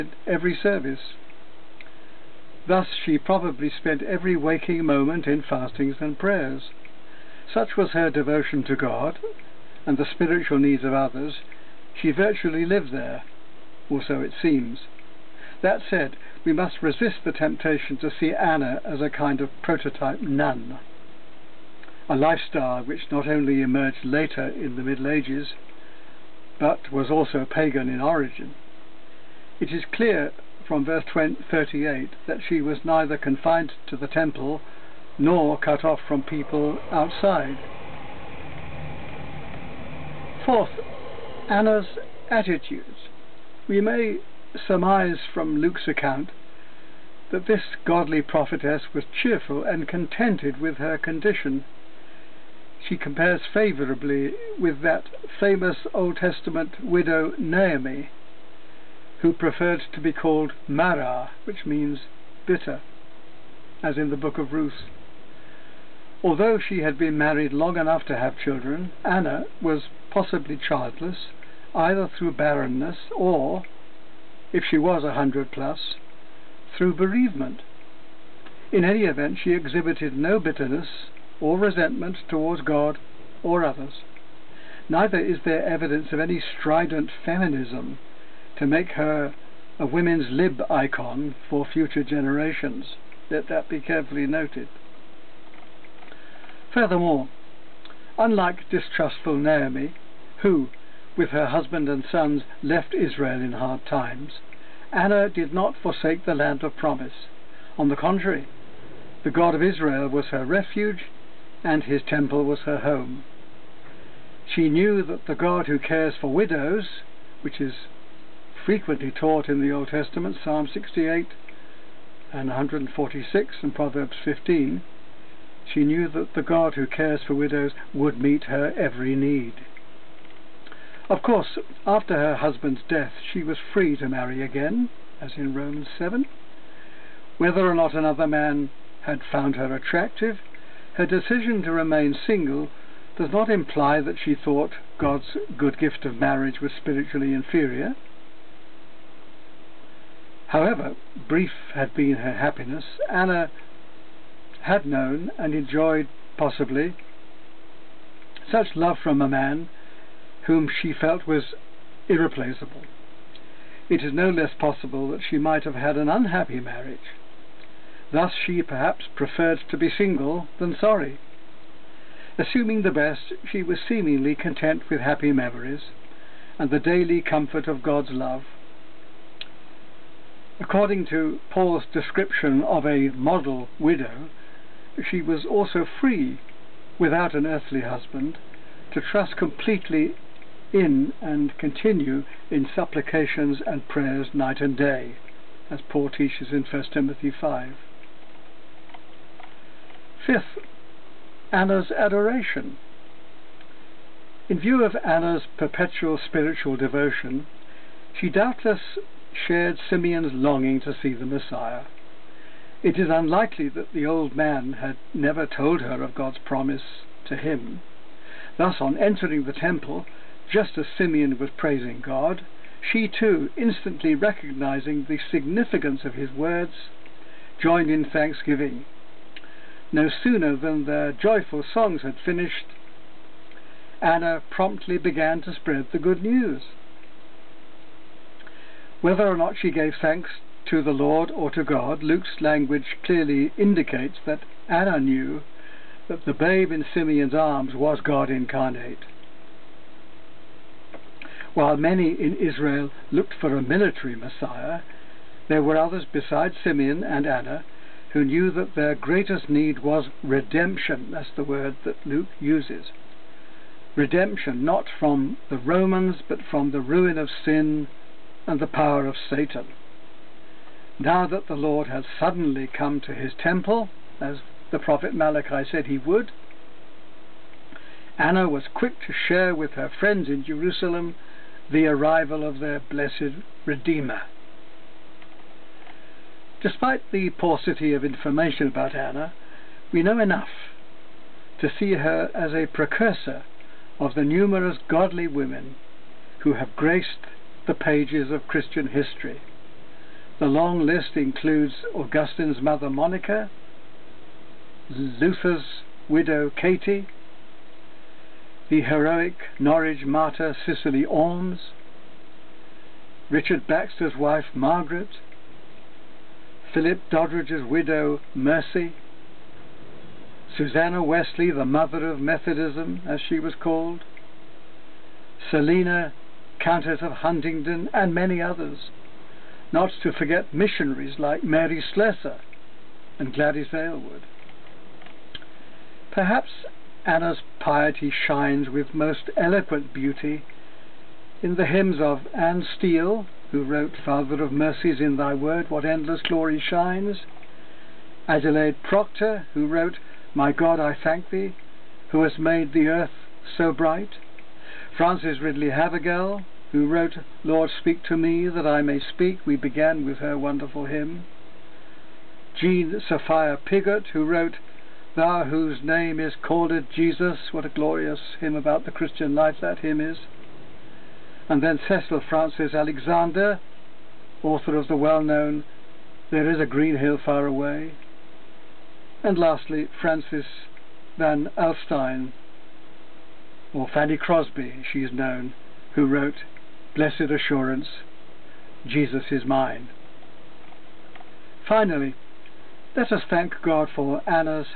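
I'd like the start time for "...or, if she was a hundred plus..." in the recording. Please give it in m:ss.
1:13.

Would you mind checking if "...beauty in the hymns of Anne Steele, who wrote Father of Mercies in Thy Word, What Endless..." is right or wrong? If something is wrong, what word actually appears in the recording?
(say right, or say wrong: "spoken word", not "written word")
right.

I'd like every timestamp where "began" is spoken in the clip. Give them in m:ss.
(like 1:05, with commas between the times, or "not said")
3:54, 5:59.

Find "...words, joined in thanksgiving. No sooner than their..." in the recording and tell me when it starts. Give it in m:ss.
3:46.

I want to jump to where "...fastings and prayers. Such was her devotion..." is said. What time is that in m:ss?
0:05.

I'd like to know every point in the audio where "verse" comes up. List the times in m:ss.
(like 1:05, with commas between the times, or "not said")
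0:30.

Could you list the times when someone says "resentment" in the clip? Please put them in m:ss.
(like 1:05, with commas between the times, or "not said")
1:21.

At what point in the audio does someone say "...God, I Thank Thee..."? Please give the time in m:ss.
5:50.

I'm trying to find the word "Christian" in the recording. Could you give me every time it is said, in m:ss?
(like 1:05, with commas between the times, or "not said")
4:58, 6:08.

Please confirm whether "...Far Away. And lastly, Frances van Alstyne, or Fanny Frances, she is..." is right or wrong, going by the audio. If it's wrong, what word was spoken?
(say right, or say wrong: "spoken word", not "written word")
wrong: "Crosby", not "Frances".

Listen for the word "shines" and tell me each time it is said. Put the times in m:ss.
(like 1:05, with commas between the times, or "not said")
5:38, 5:46.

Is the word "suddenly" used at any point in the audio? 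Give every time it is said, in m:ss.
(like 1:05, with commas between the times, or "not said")
4:32.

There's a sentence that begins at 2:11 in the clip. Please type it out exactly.
Of course, after her husband's death, she was free to marry again, as in Romans 7.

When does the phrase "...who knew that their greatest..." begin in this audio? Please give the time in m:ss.
4:18.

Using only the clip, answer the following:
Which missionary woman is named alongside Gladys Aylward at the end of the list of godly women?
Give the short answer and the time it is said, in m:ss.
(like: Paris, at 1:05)
Mary Slessor, at 5:31.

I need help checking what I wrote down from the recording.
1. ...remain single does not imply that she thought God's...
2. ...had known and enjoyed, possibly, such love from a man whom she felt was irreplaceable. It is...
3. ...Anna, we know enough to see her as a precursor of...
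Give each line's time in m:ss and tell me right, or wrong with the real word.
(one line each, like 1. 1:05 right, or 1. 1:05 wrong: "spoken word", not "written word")
1. 2:21 right
2. 2:34 right
3. 4:48 right.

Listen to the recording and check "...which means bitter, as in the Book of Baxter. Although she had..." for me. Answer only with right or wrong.
wrong.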